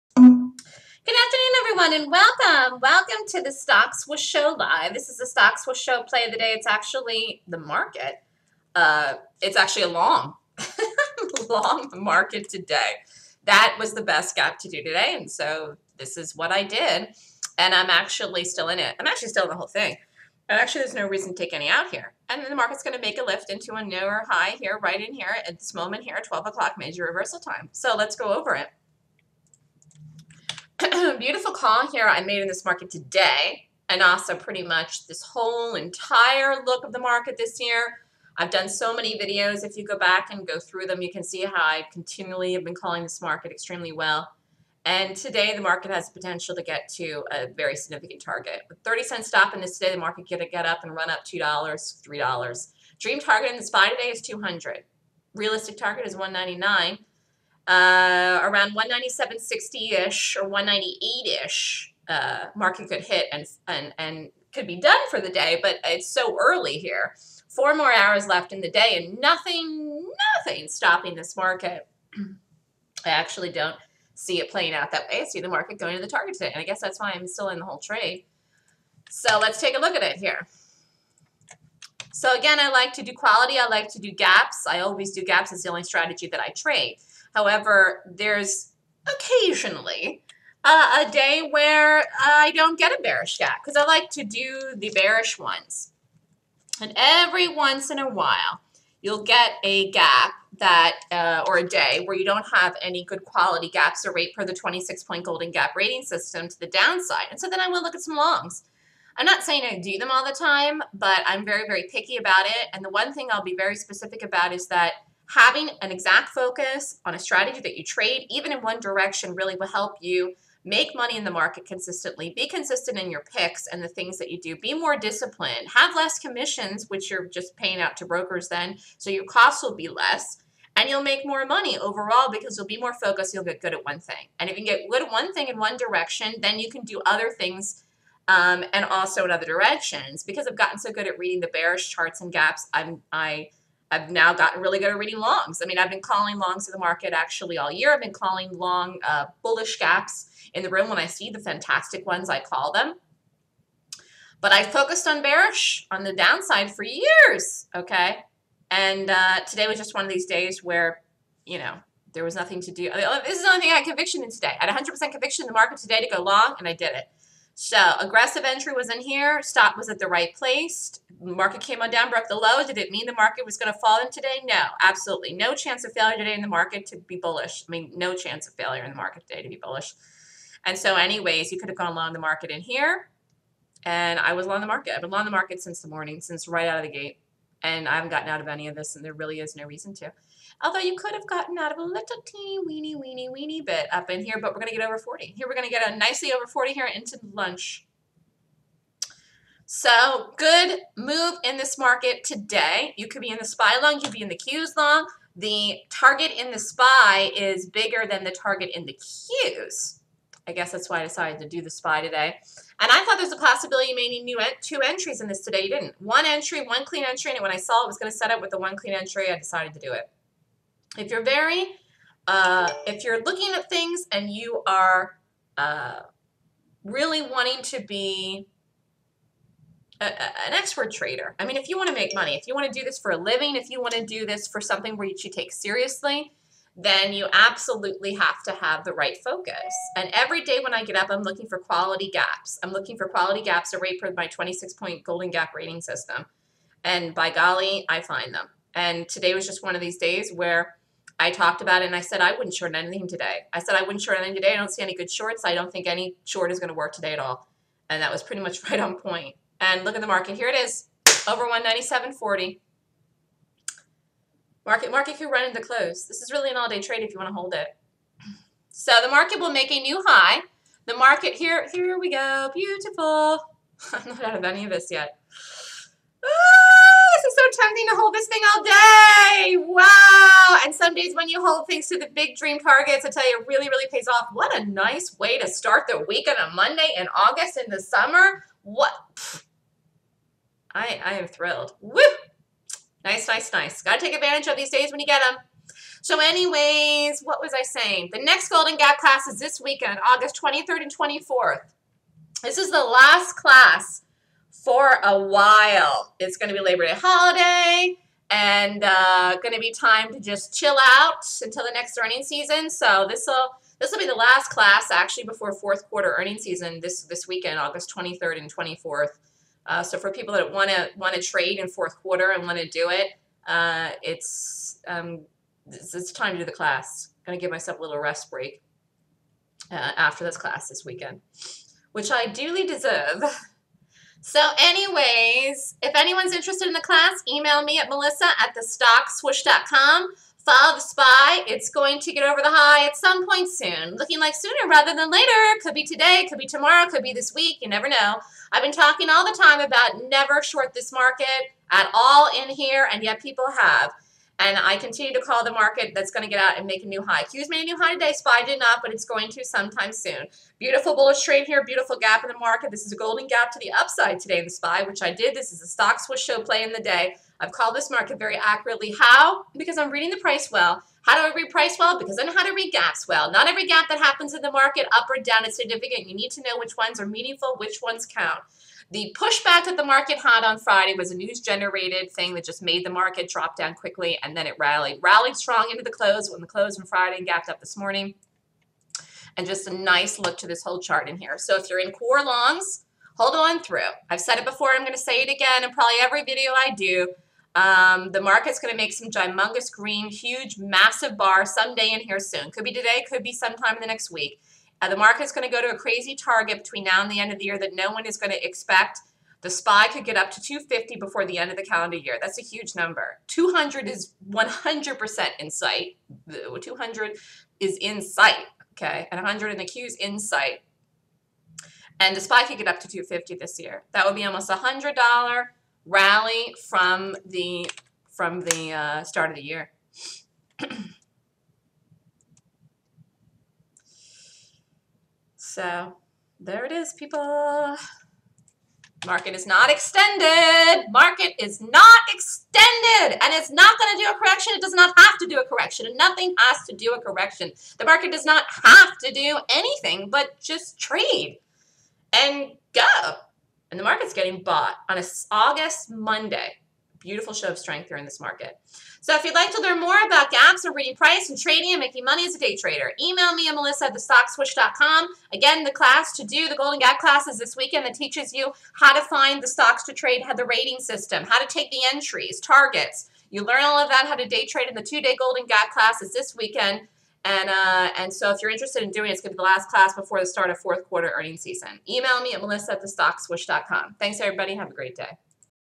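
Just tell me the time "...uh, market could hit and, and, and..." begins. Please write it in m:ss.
1:02.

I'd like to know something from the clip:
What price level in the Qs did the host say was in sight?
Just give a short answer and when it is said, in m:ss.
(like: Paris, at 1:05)
100, at 6:59.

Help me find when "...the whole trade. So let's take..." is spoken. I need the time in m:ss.
1:17.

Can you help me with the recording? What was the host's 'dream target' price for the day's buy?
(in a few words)
200.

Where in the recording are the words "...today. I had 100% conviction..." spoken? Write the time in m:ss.
2:44.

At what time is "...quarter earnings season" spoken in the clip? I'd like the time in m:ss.
8:00.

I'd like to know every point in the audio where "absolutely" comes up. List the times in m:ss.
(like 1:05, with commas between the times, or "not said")
2:54, 3:57.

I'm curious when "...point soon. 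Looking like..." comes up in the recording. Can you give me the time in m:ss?
5:43.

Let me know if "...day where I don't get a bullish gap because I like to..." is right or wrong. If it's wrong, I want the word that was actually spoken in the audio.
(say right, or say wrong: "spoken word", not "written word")
wrong: "bearish", not "bullish".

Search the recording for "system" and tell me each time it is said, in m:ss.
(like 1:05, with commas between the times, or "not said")
1:46, 4:05, 7:50.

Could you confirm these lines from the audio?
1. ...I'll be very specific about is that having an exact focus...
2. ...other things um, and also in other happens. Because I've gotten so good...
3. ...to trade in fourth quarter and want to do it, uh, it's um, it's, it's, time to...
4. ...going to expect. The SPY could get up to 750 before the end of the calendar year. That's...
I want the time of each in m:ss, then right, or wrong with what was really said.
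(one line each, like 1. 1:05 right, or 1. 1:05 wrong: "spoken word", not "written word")
1. 1:53 right
2. 2:17 wrong: "directions", not "happens"
3. 5:21 right
4. 6:48 wrong: "250", not "750".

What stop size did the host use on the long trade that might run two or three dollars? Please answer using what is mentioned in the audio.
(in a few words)
30 cents.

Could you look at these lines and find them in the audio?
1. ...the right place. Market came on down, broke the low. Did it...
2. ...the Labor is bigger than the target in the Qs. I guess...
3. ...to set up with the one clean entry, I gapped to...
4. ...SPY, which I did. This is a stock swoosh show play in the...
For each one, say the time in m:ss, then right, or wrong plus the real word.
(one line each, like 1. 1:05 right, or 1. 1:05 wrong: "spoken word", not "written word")
1. 2:49 right
2. 3:26 wrong: "SPY", not "Labor"
3. 3:38 wrong: "decided", not "gapped"
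4. 6:04 right.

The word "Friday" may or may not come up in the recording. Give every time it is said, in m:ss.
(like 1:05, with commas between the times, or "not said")
6:20, 6:26.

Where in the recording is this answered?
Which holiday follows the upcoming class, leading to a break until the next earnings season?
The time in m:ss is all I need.
5:06.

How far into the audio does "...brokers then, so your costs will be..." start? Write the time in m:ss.
2:08.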